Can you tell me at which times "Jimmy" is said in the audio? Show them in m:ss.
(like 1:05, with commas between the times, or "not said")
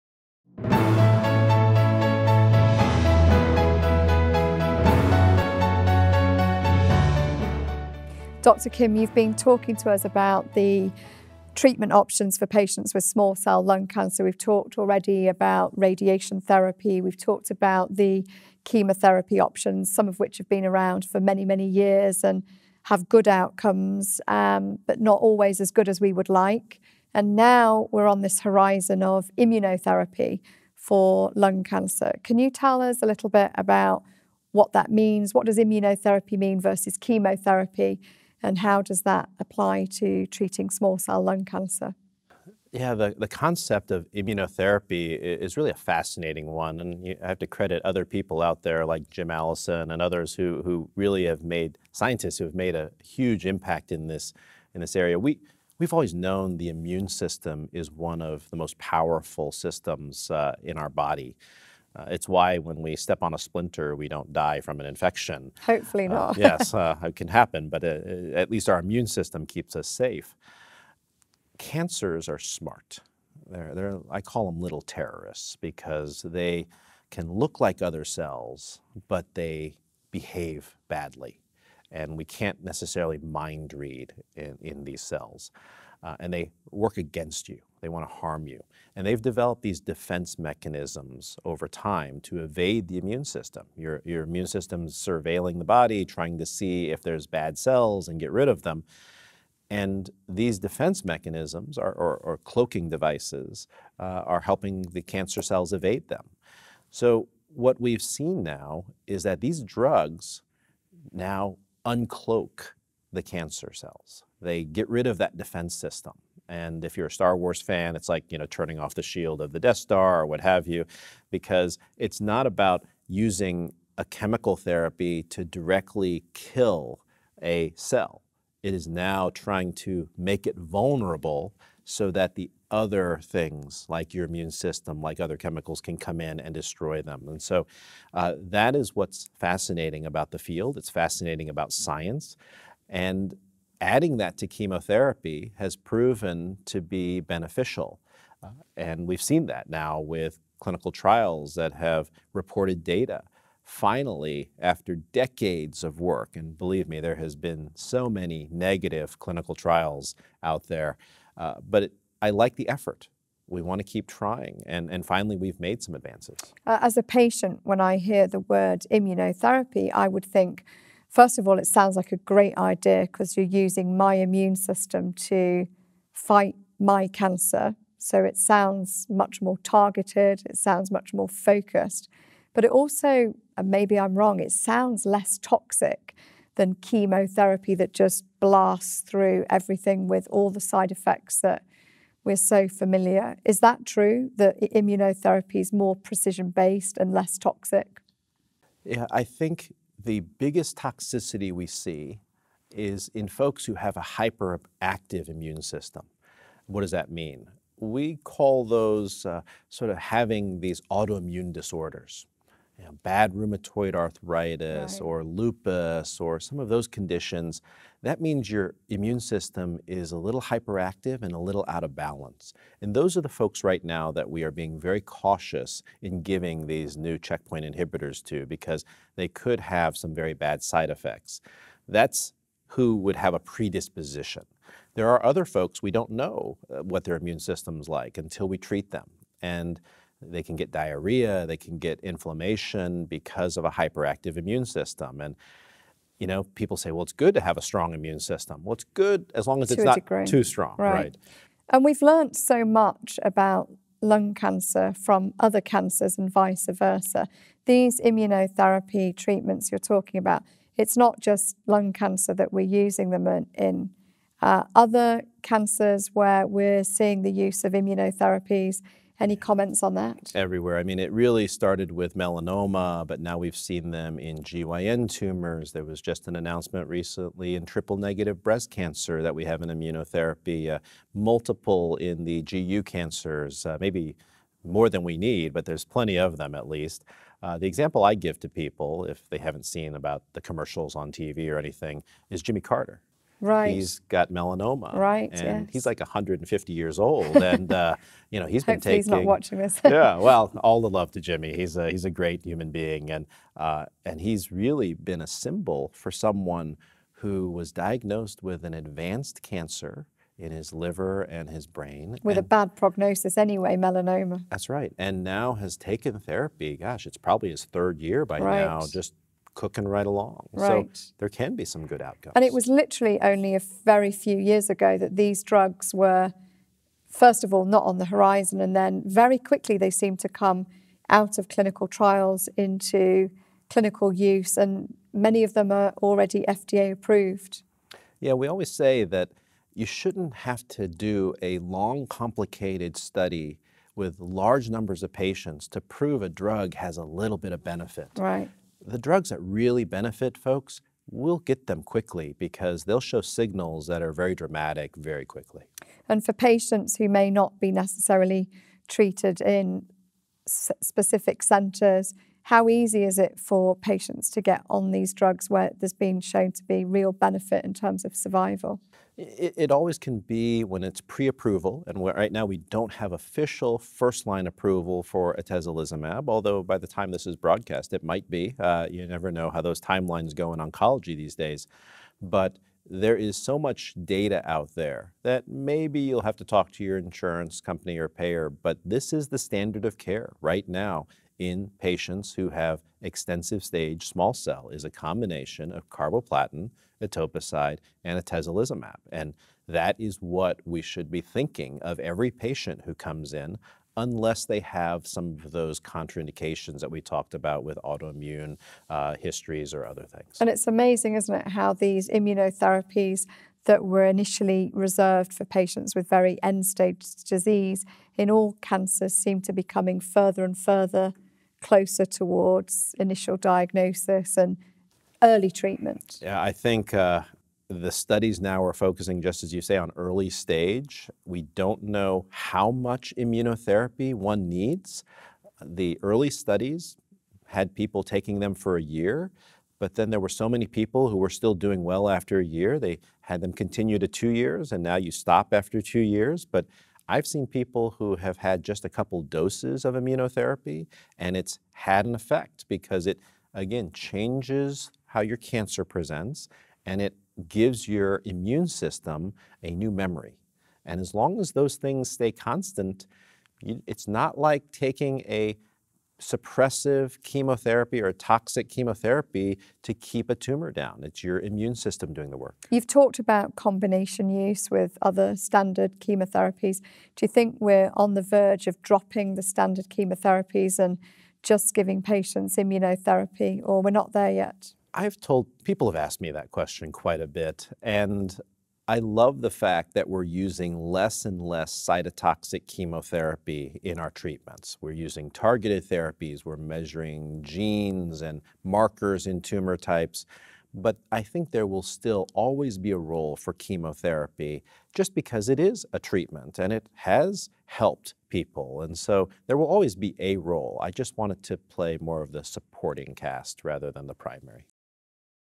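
4:52, 5:01.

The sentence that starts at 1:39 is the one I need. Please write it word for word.
And these defense mechanisms are, or, or, cloaking devices uh, are helping the cancer cells evade them.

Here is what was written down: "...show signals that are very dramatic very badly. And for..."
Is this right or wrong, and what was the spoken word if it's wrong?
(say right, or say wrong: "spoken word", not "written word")
wrong: "quickly", not "badly".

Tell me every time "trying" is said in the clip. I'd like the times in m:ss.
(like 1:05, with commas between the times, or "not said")
1:36, 2:09, 2:44.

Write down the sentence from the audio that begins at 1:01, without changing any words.
Uh, it's why when we step on a splinter, we don't die from an infection.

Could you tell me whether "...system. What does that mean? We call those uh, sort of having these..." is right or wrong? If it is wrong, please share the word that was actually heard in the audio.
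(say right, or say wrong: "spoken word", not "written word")
right.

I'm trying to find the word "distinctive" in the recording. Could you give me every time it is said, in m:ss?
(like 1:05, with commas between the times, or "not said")
not said.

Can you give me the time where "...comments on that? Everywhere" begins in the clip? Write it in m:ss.
4:29.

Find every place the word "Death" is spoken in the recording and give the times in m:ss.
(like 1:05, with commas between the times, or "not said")
1:59.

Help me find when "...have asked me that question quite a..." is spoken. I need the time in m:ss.
8:05.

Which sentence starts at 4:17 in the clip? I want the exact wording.
These immunotherapy treatments you're talking about, it's not just lung cancer that we're using them in.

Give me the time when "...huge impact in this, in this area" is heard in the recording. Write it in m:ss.
0:53.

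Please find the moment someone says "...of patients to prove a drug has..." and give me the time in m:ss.
5:45.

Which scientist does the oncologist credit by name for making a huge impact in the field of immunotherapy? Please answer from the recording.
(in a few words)
Jim Allison.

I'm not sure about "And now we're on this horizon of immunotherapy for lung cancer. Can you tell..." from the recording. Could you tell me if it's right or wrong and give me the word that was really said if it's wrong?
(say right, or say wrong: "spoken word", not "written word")
right.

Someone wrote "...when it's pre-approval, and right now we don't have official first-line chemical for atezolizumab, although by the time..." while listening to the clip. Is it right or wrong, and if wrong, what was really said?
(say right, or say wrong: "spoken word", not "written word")
wrong: "approval", not "chemical".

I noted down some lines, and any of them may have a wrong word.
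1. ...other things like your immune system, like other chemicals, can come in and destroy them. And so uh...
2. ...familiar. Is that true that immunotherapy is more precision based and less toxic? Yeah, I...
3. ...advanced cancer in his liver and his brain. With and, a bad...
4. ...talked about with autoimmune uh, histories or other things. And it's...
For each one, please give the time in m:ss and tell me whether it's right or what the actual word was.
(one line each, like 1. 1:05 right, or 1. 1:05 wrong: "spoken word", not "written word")
1. 2:12 right
2. 3:12 right
3. 5:08 right
4. 6:47 right.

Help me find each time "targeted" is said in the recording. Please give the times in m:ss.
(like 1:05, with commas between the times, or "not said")
2:59, 8:15.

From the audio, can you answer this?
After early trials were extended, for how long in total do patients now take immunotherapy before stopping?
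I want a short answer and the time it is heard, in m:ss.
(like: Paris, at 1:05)
2 years, at 7:24.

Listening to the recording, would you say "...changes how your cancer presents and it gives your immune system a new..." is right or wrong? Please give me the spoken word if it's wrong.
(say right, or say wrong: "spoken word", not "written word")
right.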